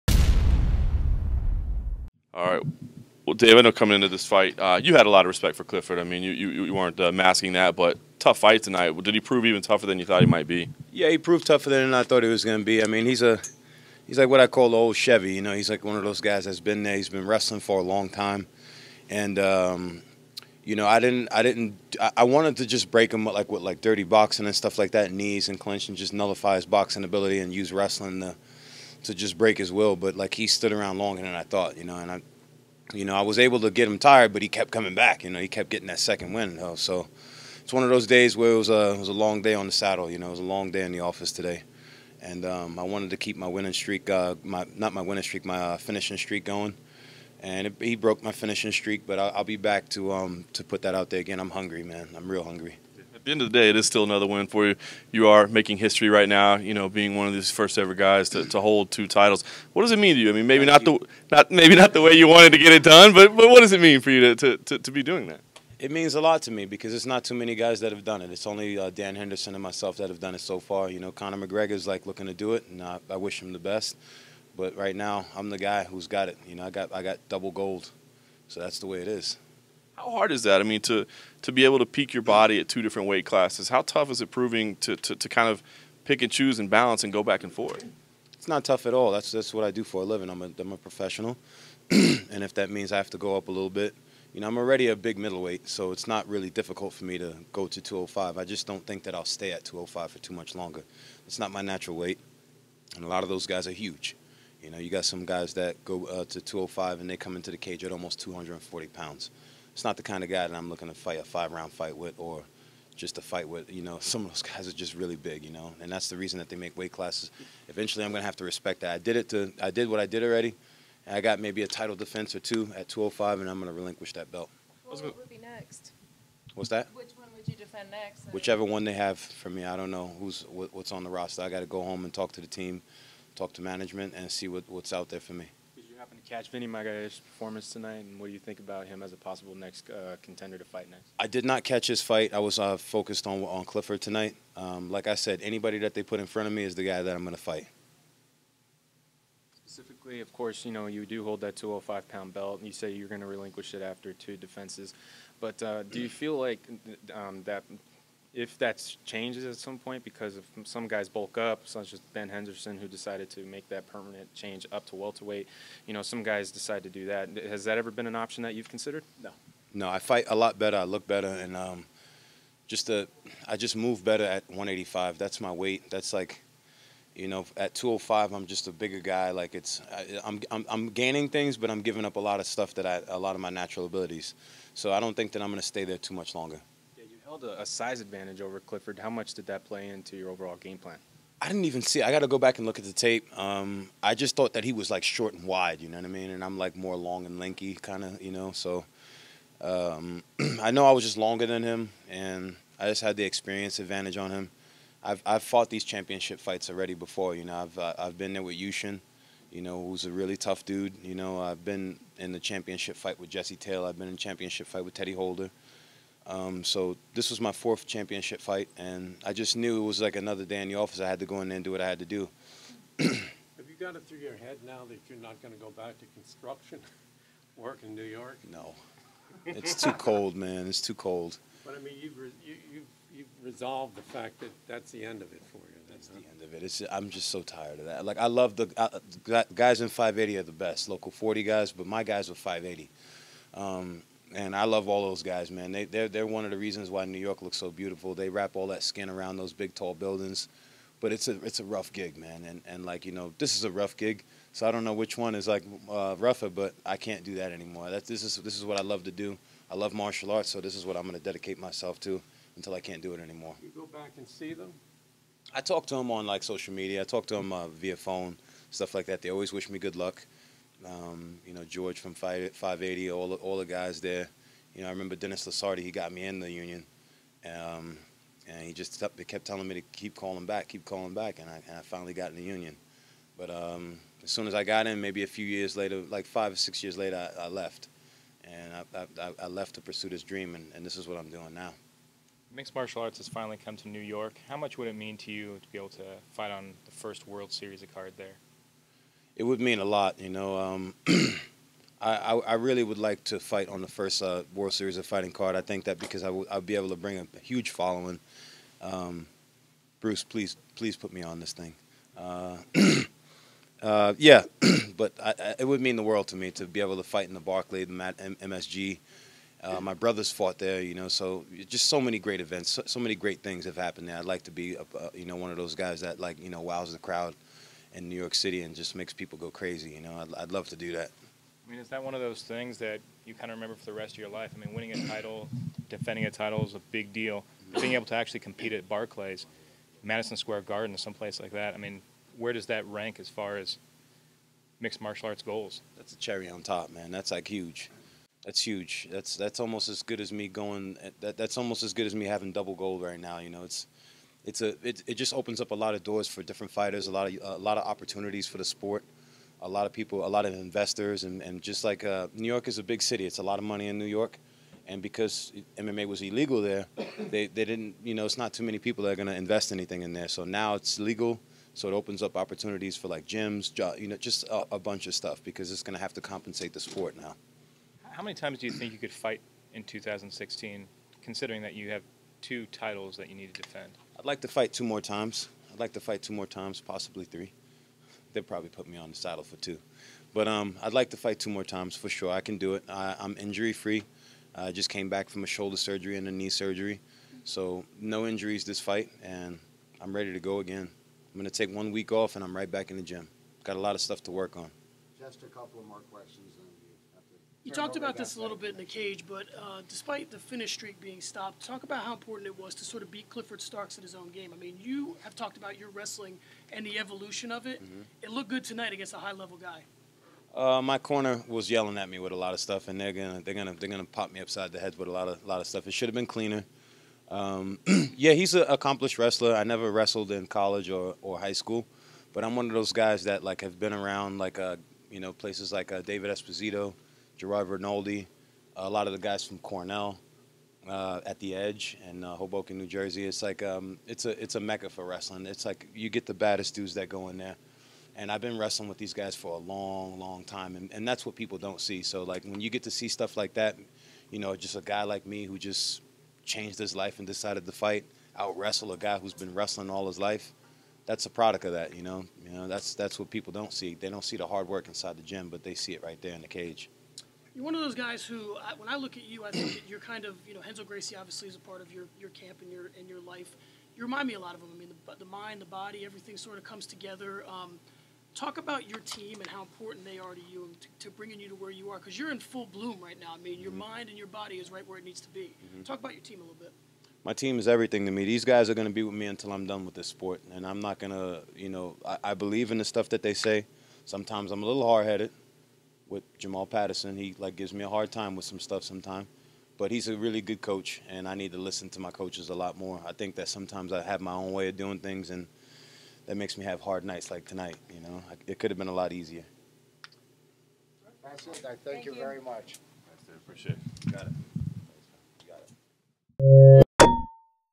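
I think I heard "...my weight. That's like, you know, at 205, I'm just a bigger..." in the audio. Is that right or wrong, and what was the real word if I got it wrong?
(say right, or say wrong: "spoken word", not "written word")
right.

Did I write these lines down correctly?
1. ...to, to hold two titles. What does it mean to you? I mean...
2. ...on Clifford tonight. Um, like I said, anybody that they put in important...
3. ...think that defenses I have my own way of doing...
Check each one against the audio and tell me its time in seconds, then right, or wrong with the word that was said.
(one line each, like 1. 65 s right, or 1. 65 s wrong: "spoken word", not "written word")
1. 58 s right
2. 143 s wrong: "front", not "important"
3. 503 s wrong: "sometimes", not "defenses".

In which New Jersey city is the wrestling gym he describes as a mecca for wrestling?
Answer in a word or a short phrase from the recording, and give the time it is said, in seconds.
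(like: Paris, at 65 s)
Hoboken, at 442 s.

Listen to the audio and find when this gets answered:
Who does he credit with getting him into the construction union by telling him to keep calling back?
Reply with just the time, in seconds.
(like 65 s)
275 s.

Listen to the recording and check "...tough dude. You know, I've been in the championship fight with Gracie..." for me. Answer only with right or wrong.
wrong.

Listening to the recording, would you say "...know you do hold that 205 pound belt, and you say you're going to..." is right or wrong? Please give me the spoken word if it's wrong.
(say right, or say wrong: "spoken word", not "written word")
right.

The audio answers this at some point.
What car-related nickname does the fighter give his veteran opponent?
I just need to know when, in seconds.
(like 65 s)
14 s.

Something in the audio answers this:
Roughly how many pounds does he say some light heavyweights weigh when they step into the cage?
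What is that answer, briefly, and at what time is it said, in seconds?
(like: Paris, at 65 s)
240, at 108 s.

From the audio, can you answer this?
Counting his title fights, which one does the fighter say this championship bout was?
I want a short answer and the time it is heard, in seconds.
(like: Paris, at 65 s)
fourth, at 217 s.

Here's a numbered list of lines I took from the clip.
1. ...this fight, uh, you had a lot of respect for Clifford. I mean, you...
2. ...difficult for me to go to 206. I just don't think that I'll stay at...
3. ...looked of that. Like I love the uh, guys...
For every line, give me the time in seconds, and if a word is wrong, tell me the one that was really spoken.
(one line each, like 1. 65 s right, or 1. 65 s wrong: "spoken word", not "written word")
1. 4 s right
2. 96 s wrong: "205", not "206"
3. 237 s wrong: "tired", not "looked".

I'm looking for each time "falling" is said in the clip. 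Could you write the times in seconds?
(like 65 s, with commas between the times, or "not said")
not said.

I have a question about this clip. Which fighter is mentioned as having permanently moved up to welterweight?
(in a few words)
Ben Henderson.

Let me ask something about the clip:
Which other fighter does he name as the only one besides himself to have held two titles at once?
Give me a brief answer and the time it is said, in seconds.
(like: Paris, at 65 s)
Dan Henderson, at 68 s.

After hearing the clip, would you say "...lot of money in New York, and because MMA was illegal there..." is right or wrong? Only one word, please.
right.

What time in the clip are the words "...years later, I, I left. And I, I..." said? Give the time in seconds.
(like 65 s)
286 s.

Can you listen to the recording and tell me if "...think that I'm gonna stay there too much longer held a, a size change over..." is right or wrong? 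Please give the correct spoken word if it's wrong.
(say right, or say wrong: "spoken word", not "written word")
wrong: "advantage", not "change".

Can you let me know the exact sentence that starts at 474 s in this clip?
I mean, the, the mind, the body, everything sort of comes together.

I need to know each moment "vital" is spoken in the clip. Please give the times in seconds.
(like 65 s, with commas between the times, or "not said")
not said.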